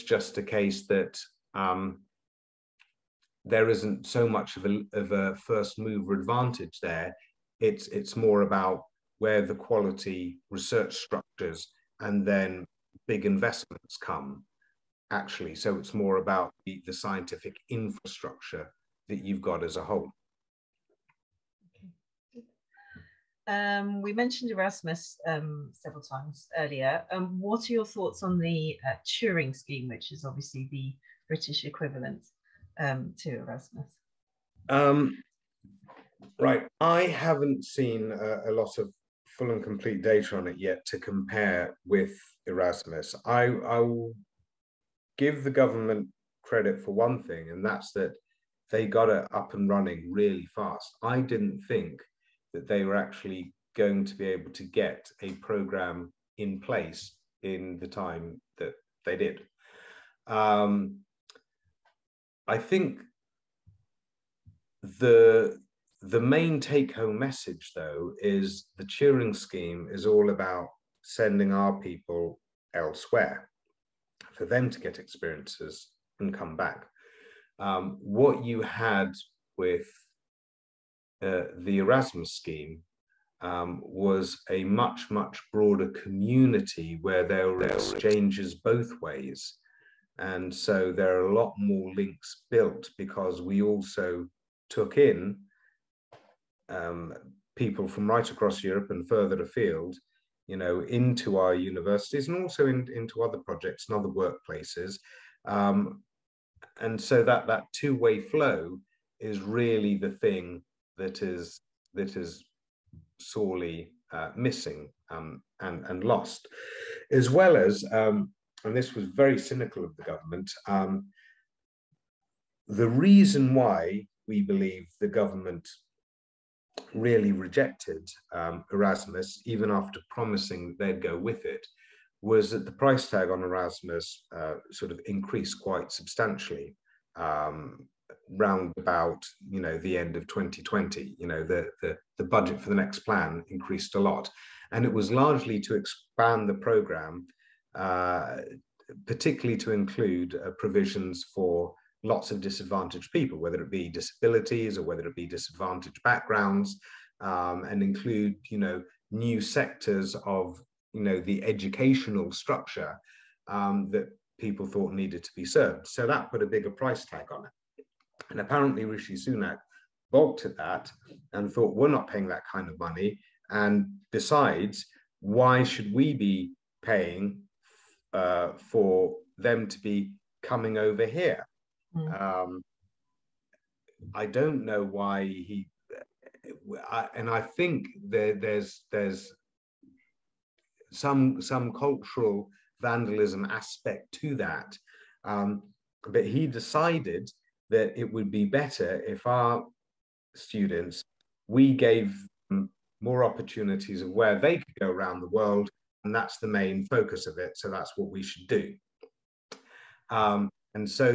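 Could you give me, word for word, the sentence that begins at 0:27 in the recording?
Um, what are your thoughts on the uh, Turing scheme, which is obviously the British equivalent um, to Erasmus?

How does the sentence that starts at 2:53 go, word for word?
And besides, why should we be paying uh, for them to be coming over here?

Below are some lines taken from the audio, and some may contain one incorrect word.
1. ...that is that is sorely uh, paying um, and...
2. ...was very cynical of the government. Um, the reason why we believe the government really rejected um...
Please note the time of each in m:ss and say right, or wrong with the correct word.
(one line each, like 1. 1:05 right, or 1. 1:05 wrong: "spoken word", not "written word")
1. 1:50 wrong: "missing", not "paying"
2. 1:58 right.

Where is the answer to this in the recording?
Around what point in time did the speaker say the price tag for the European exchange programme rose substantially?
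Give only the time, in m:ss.
2:19.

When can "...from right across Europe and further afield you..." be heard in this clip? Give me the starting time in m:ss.
1:37.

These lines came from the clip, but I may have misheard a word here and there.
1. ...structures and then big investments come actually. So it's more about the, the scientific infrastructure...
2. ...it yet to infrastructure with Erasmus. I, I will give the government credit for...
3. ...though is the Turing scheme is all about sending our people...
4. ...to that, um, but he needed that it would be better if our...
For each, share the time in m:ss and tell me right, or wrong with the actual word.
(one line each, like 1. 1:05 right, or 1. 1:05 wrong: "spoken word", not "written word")
1. 0:10 right
2. 0:40 wrong: "compare", not "infrastructure"
3. 1:07 right
4. 3:14 wrong: "decided", not "needed".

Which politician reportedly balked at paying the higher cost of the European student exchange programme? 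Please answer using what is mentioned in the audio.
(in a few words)
Rishi Sunak.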